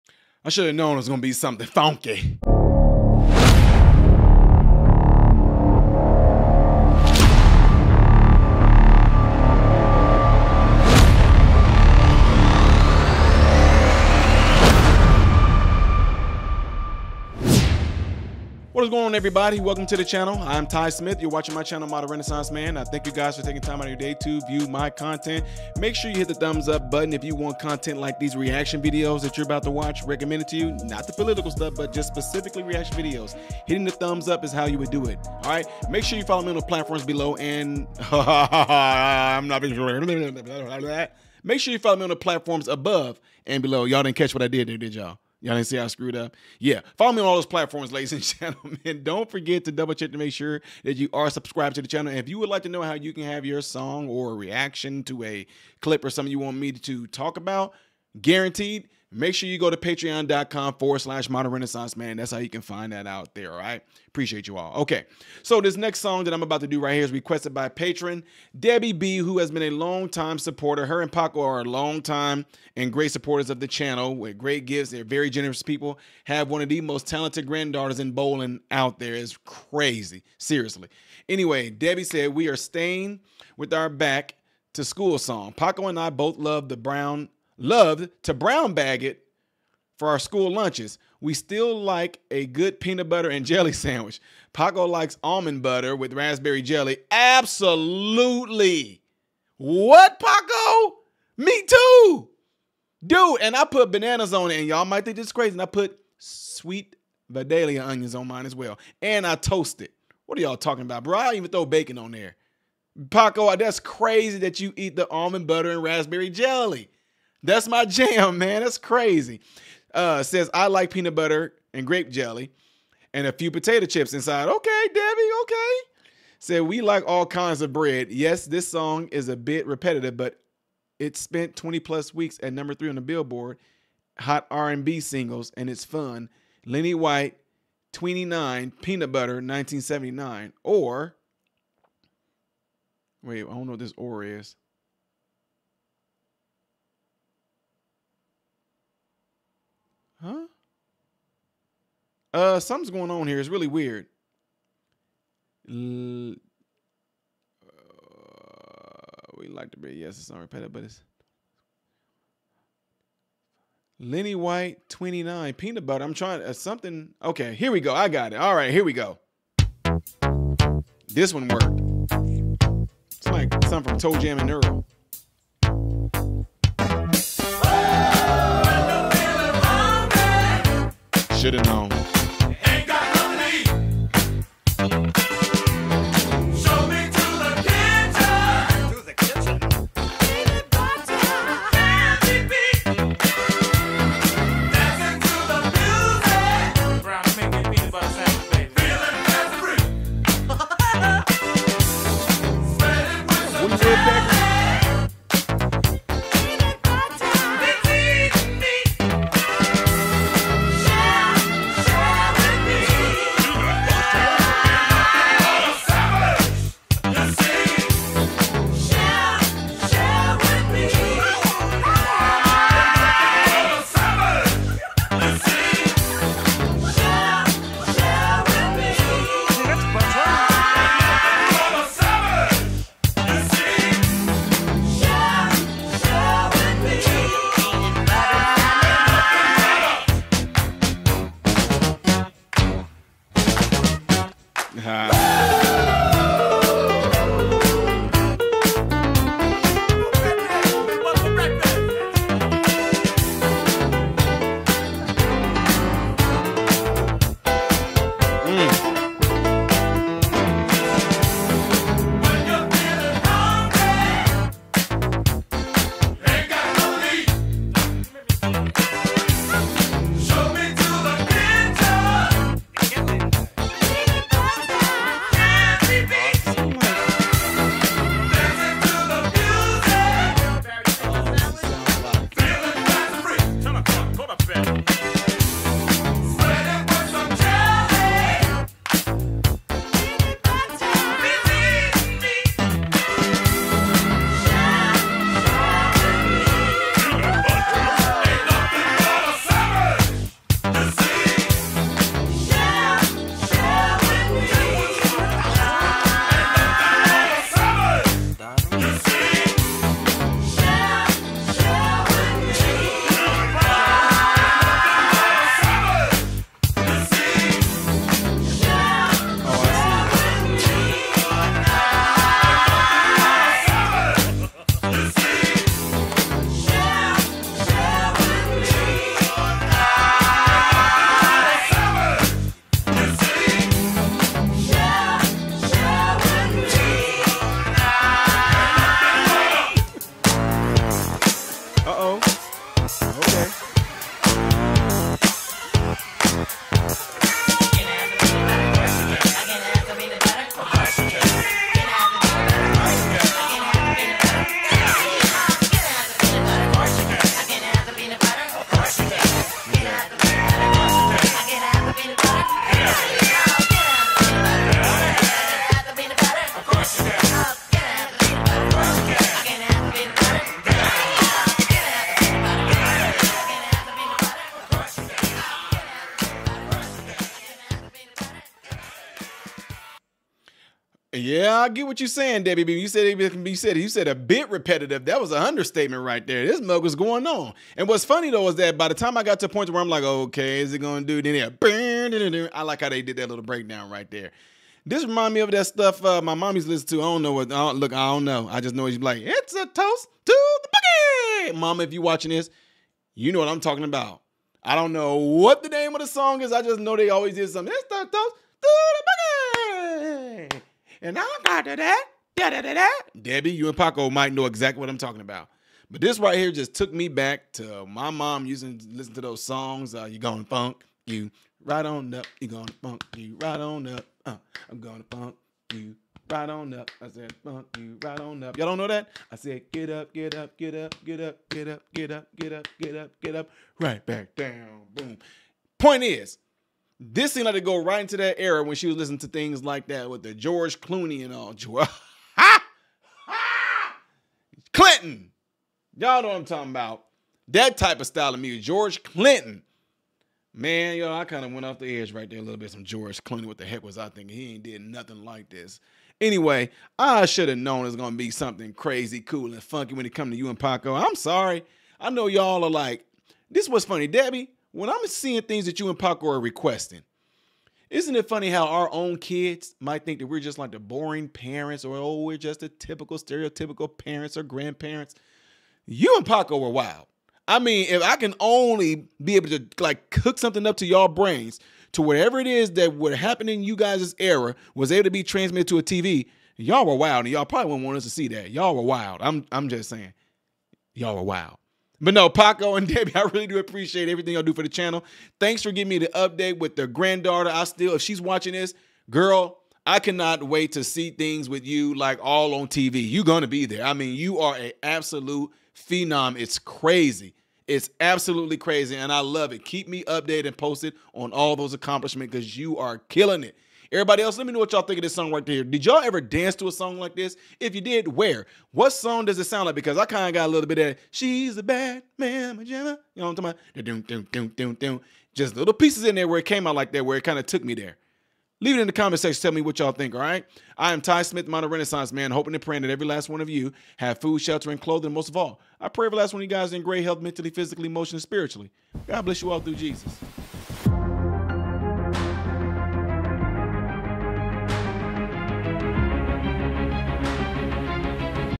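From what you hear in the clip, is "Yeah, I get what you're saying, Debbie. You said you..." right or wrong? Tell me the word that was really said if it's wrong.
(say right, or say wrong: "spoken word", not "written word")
right.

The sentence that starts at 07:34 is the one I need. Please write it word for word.
He ain't did nothing like this.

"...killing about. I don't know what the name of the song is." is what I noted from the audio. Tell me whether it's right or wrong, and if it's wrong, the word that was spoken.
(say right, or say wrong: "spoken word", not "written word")
wrong: "talking", not "killing".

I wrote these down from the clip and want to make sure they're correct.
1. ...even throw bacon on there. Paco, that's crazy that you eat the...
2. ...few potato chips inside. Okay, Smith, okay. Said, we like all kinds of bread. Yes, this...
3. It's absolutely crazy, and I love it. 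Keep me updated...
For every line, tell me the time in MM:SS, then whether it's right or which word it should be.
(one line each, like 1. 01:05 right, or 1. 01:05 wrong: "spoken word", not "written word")
1. 01:51 right
2. 02:03 wrong: "Debbie", not "Smith"
3. 08:27 right.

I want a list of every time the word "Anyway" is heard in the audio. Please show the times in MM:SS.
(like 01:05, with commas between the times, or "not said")
01:21, 07:36.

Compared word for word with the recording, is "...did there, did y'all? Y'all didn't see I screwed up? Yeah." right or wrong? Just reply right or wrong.
right.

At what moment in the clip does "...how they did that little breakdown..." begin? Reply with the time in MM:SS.
06:32.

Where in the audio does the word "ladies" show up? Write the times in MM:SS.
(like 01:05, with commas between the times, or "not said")
00:47.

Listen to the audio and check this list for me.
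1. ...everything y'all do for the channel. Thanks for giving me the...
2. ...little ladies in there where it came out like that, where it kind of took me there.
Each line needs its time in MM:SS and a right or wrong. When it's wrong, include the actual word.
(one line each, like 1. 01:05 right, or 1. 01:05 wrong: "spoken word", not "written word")
1. 08:14 right
2. 08:45 wrong: "pieces", not "ladies".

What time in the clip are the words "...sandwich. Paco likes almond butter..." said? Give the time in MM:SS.
01:33.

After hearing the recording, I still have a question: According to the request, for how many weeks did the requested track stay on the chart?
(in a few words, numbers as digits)
20 plus weeks.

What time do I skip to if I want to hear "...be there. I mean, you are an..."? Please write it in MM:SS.
08:23.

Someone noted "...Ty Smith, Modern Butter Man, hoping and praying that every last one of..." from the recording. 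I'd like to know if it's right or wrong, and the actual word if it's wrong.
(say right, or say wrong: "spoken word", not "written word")
wrong: "Renaissance", not "Butter".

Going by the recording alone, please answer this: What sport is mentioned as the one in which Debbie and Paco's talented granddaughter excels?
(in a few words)
bowling.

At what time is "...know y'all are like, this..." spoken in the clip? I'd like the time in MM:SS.
07:42.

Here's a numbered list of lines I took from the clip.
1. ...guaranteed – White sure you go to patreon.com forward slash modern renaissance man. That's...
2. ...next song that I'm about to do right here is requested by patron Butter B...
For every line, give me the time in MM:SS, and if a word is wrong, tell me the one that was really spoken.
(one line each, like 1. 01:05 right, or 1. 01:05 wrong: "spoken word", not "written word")
1. 00:58 wrong: "Make", not "White"
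2. 01:05 wrong: "Debbie", not "Butter".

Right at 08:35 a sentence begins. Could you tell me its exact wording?
Did y'all ever dance to a song like this?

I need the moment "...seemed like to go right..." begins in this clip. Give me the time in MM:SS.
07:17.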